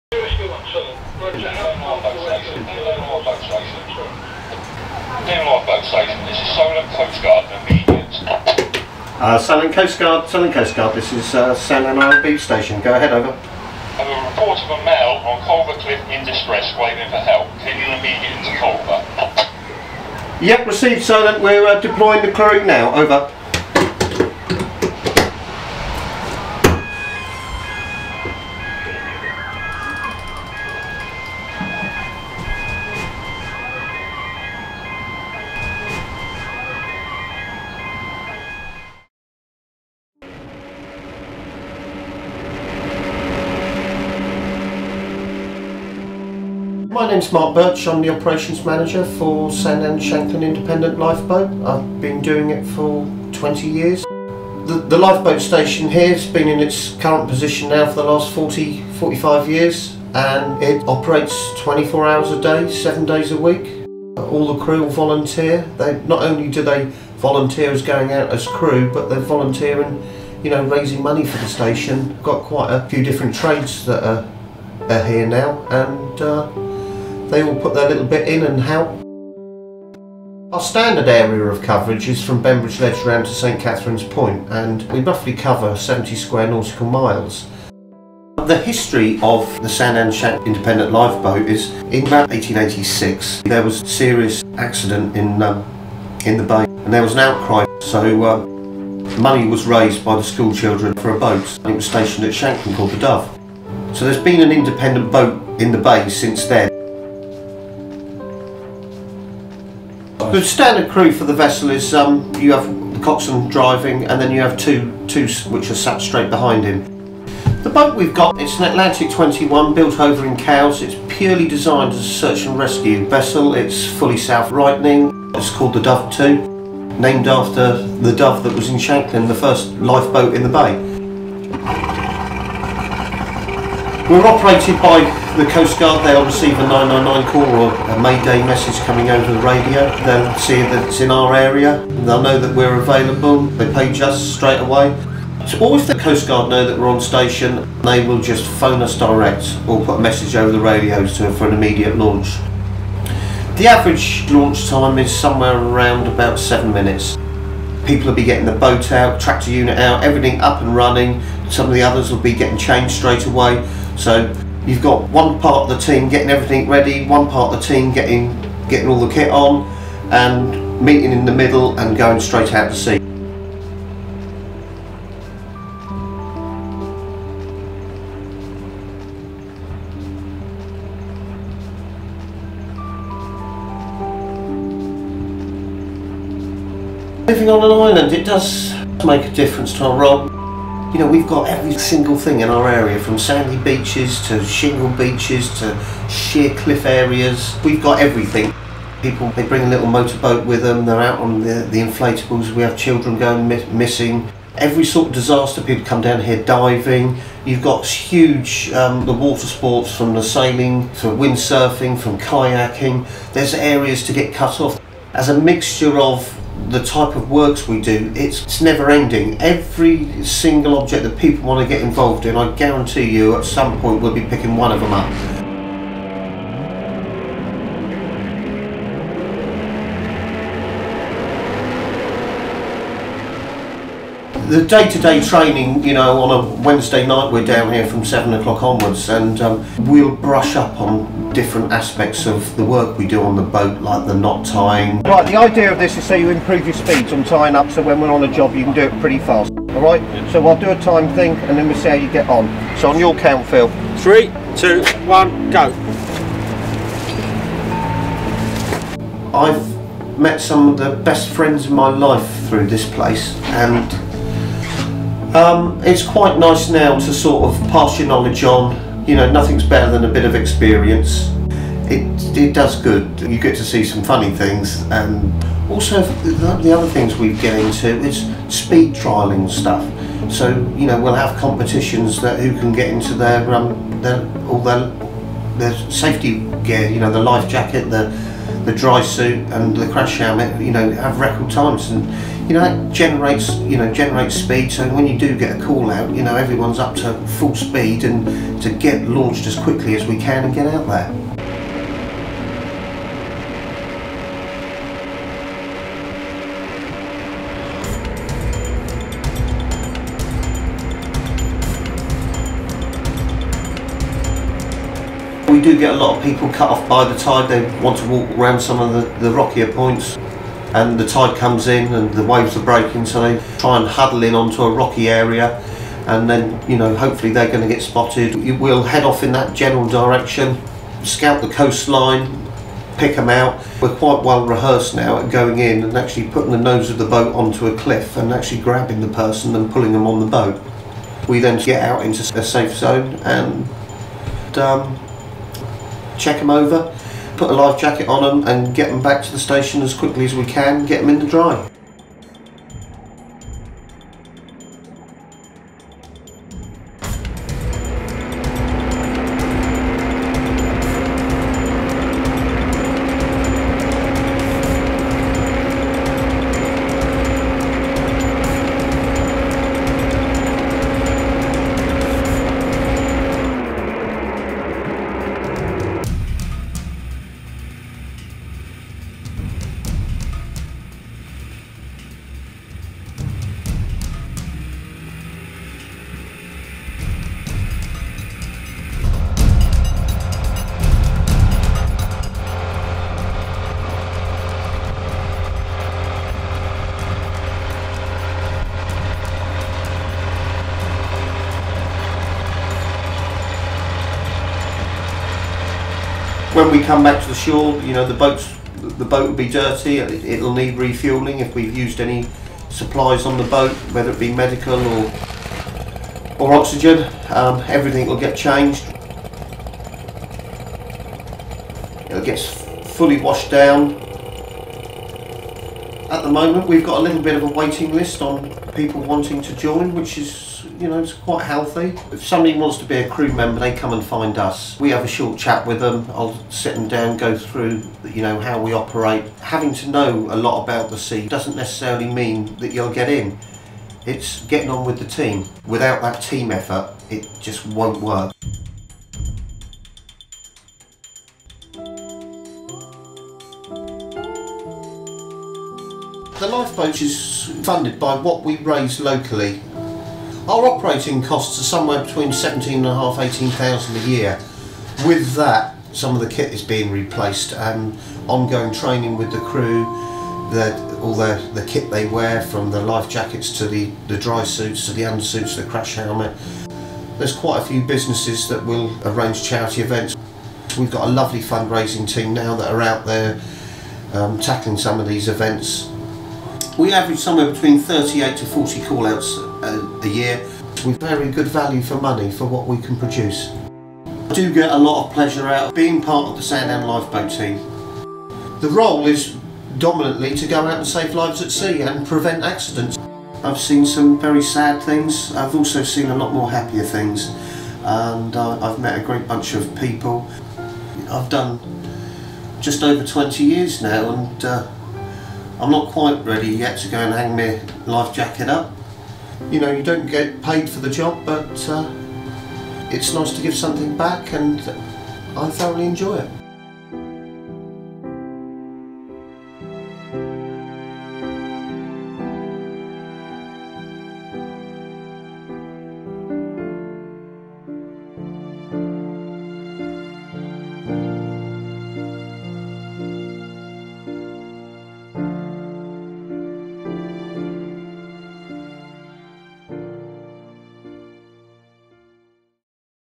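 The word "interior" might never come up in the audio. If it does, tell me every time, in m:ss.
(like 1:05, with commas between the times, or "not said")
not said.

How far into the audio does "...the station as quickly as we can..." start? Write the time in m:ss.
5:49.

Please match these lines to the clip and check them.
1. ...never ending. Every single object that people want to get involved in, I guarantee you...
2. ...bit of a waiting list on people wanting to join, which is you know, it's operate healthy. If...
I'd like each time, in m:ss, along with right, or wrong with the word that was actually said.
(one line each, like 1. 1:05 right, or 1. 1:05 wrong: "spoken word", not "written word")
1. 3:38 right
2. 7:07 wrong: "quite", not "operate".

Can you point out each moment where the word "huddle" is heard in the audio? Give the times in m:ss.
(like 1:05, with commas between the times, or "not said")
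5:23.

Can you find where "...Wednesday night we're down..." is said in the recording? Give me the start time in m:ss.
3:56.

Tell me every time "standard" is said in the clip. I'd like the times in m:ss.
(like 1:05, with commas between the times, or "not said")
1:20, 1:50.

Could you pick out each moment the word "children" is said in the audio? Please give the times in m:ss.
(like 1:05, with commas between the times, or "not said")
1:40, 3:22.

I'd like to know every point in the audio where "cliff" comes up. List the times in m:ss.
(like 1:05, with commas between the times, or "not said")
0:15, 3:16, 5:37.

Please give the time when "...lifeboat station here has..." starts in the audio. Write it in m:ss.
0:54.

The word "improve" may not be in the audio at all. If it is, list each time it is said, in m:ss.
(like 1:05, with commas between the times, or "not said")
4:06.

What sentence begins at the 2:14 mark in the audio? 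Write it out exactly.
We're operated by the Coast Guard, they'll receive a 999 call or a Mayday message coming over the radio.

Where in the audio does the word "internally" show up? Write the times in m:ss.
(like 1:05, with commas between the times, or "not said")
not said.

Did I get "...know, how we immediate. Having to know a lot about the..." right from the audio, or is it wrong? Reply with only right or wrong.
wrong.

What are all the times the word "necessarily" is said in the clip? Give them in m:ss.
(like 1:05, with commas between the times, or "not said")
7:21.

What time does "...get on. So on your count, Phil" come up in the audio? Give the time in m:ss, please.
4:12.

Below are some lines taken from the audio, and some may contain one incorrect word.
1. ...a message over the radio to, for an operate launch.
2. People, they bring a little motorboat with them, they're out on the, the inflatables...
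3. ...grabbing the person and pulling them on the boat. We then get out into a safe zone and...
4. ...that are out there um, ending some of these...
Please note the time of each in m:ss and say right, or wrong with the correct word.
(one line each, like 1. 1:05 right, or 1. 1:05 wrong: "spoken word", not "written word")
1. 2:29 wrong: "immediate", not "operate"
2. 3:19 right
3. 5:38 right
4. 8:02 wrong: "tackling", not "ending".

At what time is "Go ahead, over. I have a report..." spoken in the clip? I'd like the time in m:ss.
0:12.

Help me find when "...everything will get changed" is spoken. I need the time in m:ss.
6:57.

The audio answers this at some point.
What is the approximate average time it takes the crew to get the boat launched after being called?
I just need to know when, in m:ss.
2:36.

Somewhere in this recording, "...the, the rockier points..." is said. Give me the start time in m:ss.
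5:18.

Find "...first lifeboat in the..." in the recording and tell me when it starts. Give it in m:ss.
2:09.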